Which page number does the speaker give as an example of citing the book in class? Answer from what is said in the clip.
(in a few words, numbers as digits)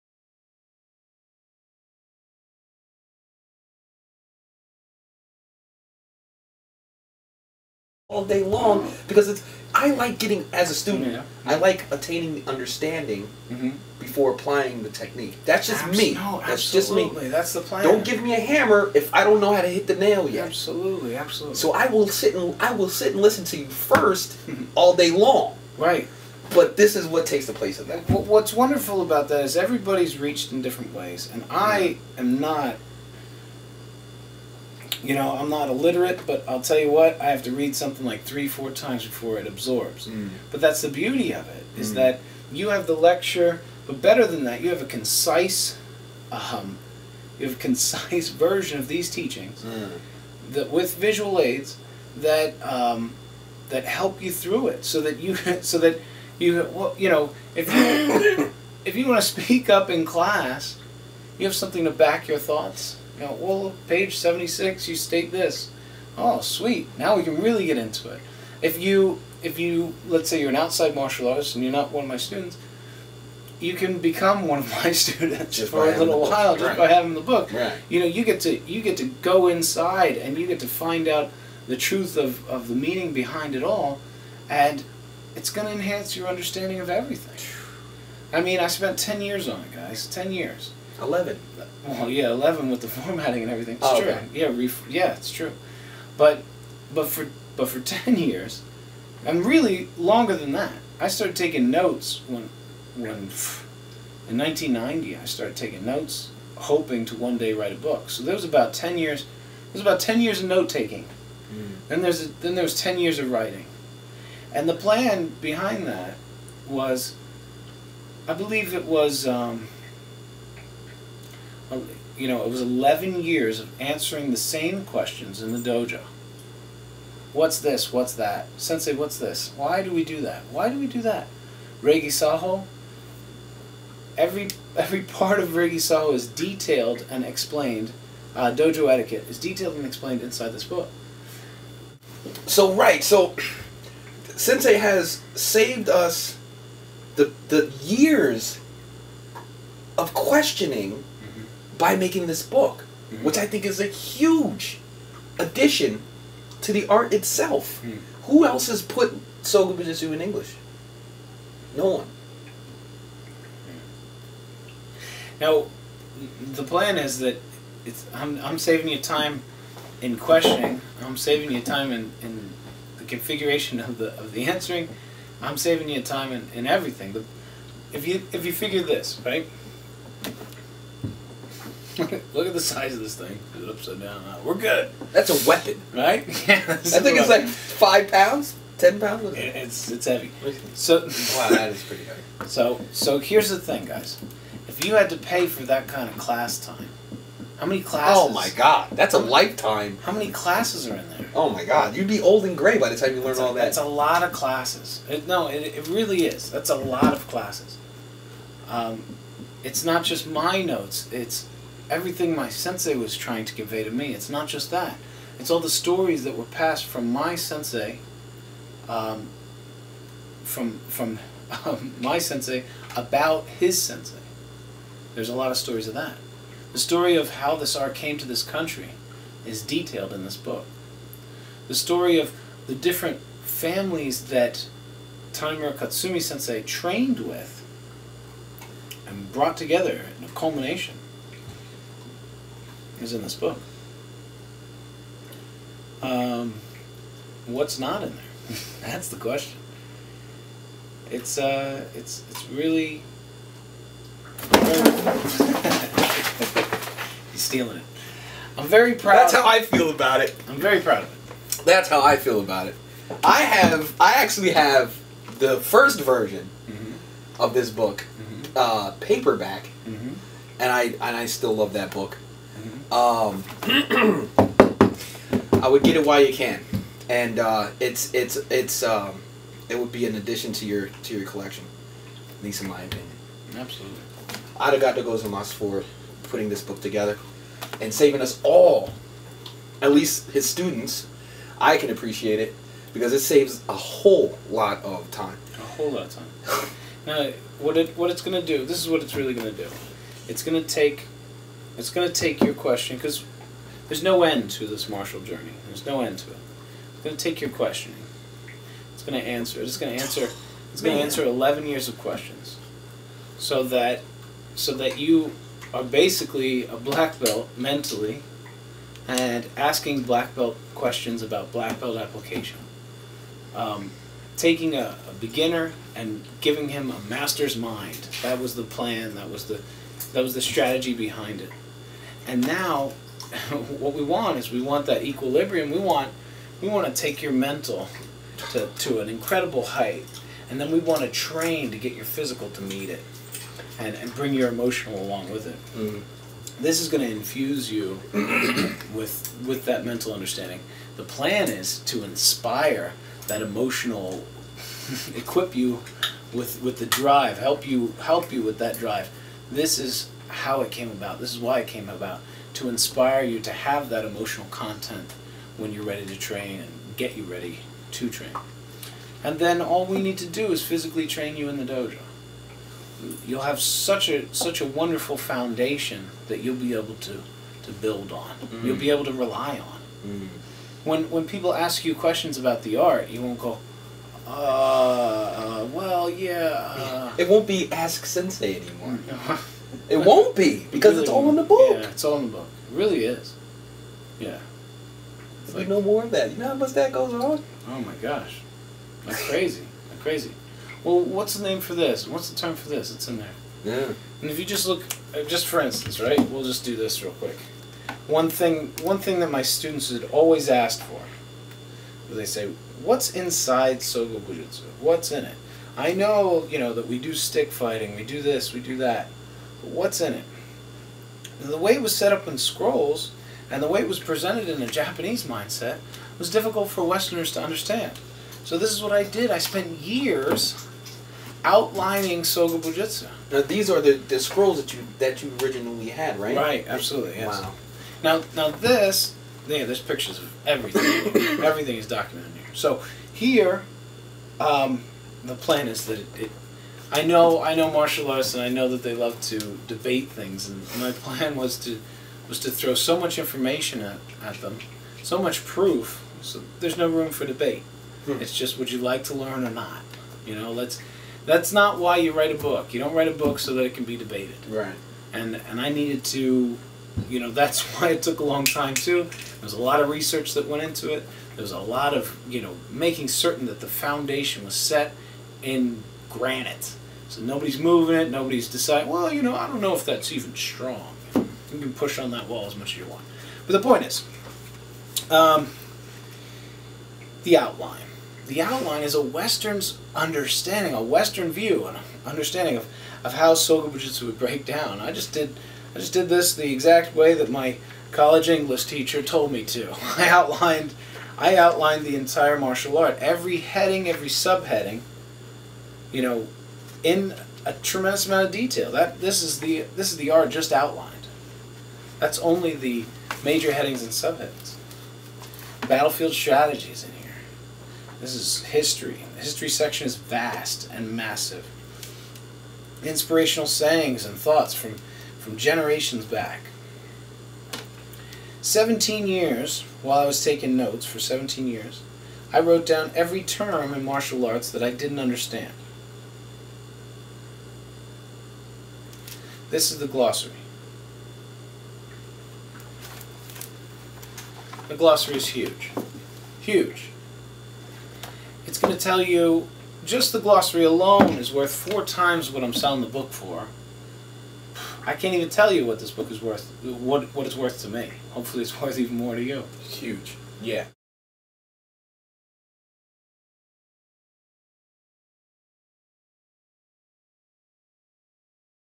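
76.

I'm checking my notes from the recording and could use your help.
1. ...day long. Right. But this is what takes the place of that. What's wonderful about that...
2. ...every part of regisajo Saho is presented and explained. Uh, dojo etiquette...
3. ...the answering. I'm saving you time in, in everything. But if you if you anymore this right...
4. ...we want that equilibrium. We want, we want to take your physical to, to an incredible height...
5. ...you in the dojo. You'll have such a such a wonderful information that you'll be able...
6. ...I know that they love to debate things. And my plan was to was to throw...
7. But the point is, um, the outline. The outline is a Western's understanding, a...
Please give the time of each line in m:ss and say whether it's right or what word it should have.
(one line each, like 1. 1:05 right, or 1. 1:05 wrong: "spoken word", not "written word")
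1. 0:25 right
2. 2:14 wrong: "detailed", not "presented"
3. 2:54 wrong: "figure", not "anymore"
4. 5:34 wrong: "mental", not "physical"
5. 6:11 wrong: "foundation", not "information"
6. 7:28 right
7. 8:03 right.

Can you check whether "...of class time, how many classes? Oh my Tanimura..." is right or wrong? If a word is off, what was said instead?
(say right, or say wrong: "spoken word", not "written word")
wrong: "God", not "Tanimura".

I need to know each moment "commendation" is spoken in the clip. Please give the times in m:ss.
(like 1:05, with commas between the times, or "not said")
not said.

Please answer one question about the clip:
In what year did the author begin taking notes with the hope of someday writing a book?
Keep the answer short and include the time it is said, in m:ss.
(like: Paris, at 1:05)
1990, at 1:44.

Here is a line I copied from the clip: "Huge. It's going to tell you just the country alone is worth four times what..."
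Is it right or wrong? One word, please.
wrong.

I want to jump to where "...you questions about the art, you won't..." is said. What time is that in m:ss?
6:21.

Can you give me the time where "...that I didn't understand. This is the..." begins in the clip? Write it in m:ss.
8:54.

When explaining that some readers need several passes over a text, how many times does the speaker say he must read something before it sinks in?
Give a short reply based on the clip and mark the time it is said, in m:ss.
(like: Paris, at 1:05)
3 or 4 times, at 0:38.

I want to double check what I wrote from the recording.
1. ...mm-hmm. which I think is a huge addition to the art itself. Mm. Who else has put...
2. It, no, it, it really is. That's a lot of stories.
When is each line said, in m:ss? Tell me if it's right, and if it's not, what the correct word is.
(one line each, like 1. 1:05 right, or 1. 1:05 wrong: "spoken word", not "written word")
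1. 2:33 right
2. 3:25 wrong: "classes", not "stories".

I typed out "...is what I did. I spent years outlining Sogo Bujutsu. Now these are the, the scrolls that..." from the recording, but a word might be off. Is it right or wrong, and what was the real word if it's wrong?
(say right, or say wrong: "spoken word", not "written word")
right.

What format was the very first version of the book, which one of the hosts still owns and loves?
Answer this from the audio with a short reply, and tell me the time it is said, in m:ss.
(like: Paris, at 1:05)
Paperback, at 4:29.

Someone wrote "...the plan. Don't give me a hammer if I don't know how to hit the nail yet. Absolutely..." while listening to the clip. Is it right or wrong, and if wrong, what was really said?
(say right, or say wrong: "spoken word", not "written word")
right.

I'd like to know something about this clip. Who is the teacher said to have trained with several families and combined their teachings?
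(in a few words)
Tanimura Katsumi.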